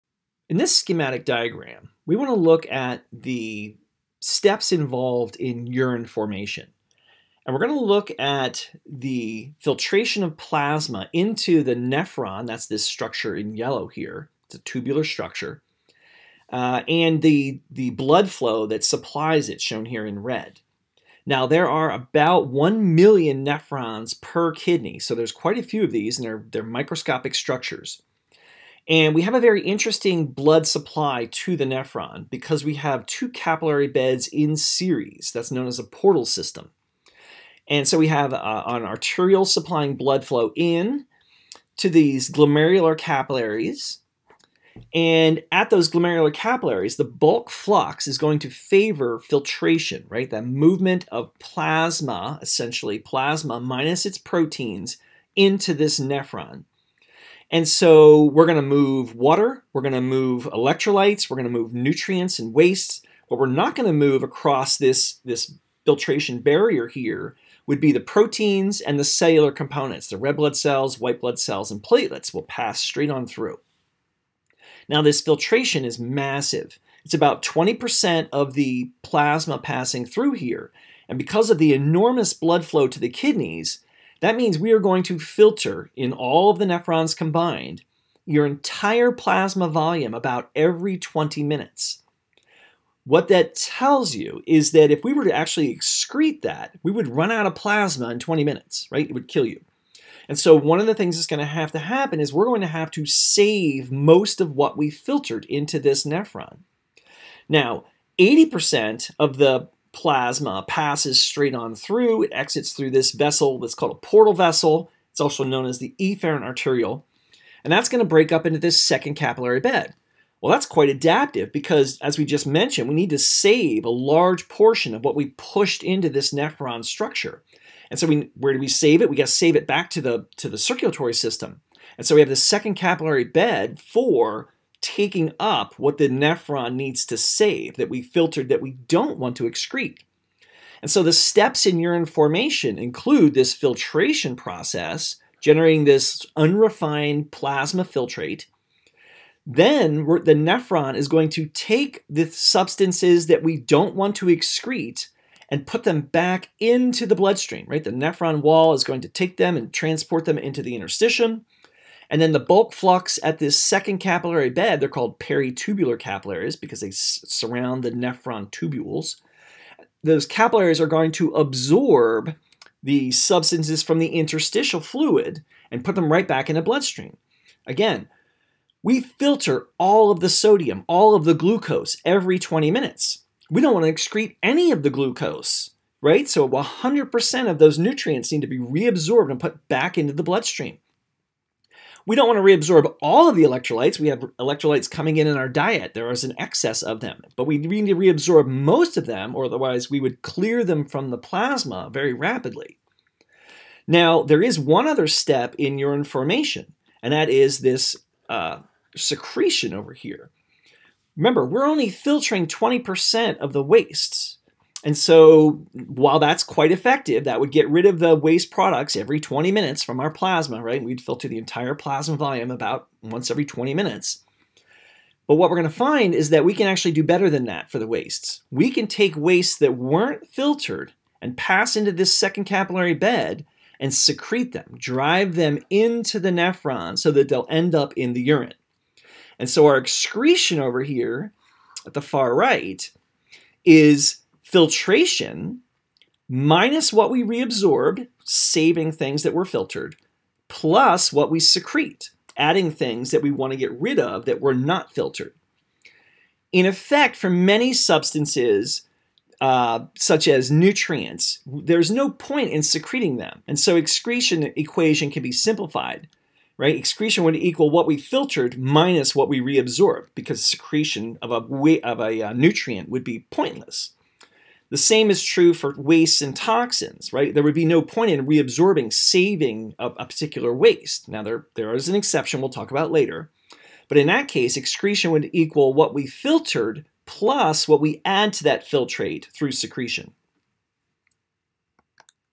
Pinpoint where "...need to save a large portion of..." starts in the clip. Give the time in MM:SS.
02:02.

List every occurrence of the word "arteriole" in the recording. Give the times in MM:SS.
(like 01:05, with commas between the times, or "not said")
00:38, 01:56.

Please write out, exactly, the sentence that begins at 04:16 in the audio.
In effect, for many substances, uh, such as nutrients, there's no point in secreting them.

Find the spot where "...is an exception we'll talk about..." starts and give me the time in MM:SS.
04:41.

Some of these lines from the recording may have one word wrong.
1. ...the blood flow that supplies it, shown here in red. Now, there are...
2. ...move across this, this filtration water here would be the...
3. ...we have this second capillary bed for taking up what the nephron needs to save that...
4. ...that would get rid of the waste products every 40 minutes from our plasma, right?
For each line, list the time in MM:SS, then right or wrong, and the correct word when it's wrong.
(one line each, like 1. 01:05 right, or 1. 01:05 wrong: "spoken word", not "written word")
1. 00:17 right
2. 01:03 wrong: "barrier", not "water"
3. 02:12 right
4. 03:37 wrong: "20", not "40".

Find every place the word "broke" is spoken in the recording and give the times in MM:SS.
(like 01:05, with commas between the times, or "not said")
not said.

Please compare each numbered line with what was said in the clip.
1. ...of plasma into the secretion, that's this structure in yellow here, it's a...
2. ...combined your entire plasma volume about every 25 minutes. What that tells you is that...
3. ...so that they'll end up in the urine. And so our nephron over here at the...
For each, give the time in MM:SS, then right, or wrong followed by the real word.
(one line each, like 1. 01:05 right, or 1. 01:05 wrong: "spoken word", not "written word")
1. 00:10 wrong: "nephron", not "secretion"
2. 01:27 wrong: "20", not "25"
3. 03:56 wrong: "excretion", not "nephron".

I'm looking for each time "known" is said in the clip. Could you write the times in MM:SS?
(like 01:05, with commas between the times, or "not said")
00:35, 01:55.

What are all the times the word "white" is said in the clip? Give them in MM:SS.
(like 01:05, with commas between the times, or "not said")
01:10.